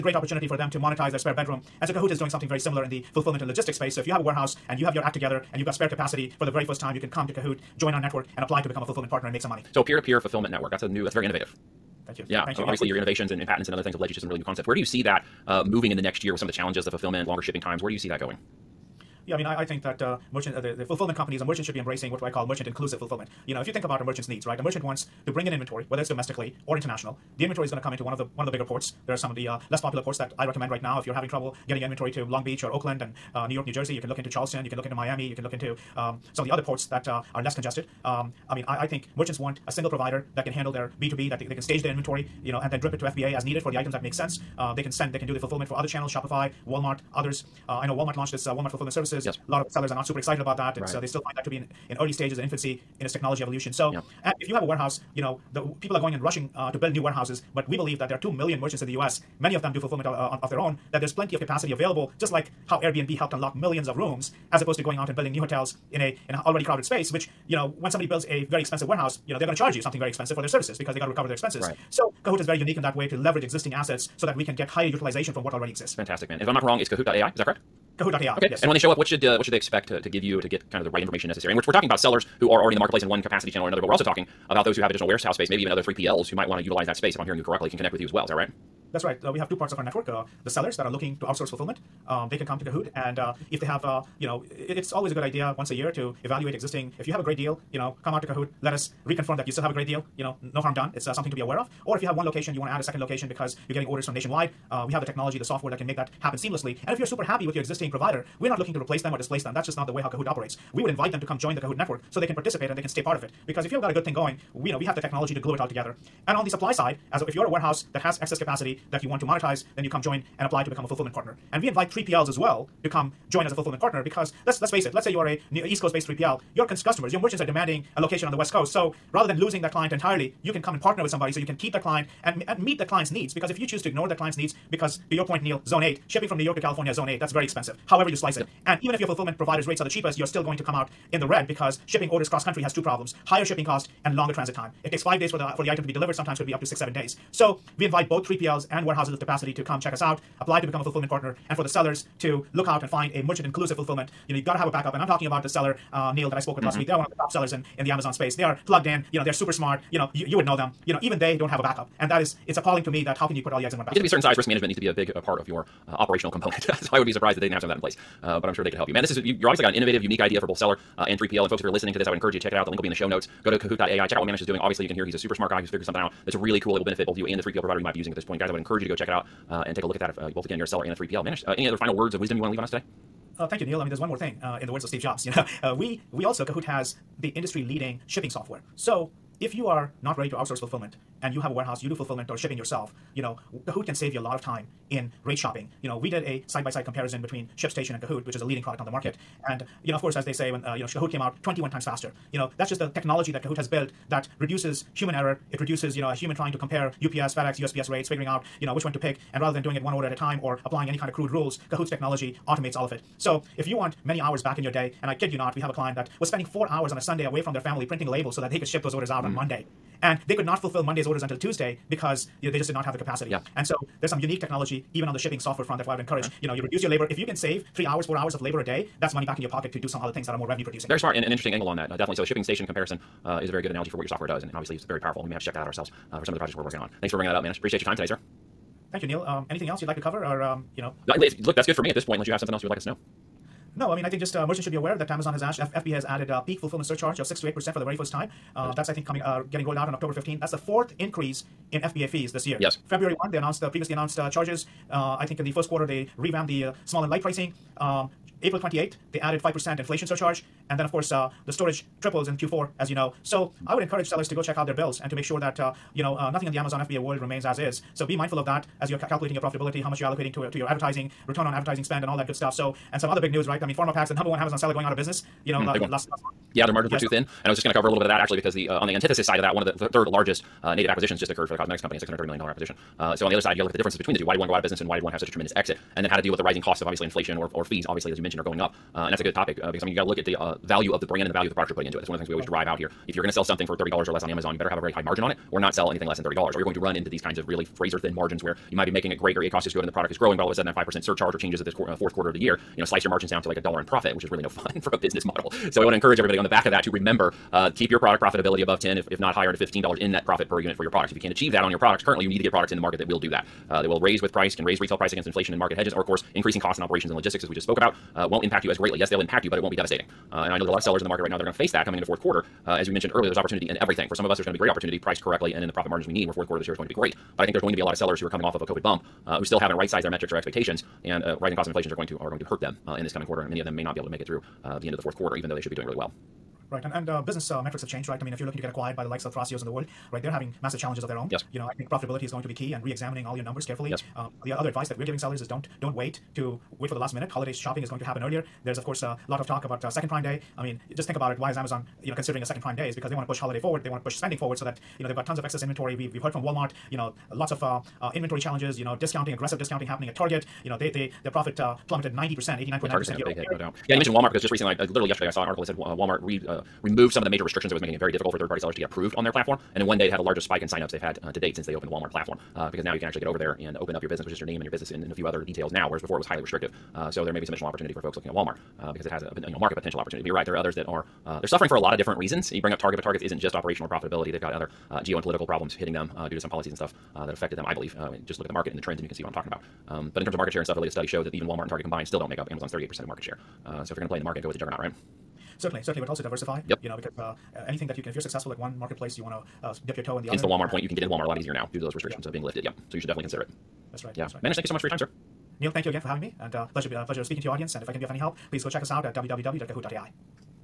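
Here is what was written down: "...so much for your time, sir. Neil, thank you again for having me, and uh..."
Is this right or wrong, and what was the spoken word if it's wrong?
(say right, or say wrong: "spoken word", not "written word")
right.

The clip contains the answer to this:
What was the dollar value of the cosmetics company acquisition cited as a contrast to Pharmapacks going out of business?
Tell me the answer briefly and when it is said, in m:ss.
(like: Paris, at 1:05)
$630 million, at 4:41.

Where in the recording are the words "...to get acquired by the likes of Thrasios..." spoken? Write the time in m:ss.
5:38.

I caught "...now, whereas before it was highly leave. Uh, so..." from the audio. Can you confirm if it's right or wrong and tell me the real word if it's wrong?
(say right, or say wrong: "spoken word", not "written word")
wrong: "restrictive", not "leave".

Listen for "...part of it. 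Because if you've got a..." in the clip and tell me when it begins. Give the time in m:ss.
1:53.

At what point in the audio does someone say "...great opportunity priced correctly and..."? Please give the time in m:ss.
5:24.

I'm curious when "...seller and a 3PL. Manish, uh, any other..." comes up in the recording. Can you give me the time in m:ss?
3:00.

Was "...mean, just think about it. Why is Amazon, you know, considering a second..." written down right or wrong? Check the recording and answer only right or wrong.
right.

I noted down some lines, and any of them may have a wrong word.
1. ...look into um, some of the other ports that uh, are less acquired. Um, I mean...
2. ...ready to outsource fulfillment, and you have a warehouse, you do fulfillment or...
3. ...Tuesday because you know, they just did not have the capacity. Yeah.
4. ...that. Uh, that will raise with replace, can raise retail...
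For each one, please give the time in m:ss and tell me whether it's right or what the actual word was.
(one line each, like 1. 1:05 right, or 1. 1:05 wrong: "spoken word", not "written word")
1. 0:35 wrong: "congested", not "acquired"
2. 3:10 right
3. 3:41 right
4. 5:13 wrong: "price", not "replace".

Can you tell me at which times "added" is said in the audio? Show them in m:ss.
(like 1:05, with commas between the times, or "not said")
4:06, 4:19.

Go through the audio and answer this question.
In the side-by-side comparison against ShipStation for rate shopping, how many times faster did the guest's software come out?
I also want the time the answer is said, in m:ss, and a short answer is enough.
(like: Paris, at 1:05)
21 times, at 3:21.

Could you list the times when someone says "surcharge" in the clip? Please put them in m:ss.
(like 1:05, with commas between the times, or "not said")
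4:06, 4:20, 5:01.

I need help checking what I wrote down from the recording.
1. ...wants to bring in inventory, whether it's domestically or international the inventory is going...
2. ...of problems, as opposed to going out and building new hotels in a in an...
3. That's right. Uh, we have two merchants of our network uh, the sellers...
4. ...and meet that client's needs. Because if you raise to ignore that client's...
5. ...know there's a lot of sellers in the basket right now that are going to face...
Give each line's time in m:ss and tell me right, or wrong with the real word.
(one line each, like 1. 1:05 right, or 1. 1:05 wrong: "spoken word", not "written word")
1. 0:24 right
2. 1:03 wrong: "rooms", not "problems"
3. 1:28 wrong: "parts", not "merchants"
4. 2:12 wrong: "choose", not "raise"
5. 5:20 wrong: "market", not "basket".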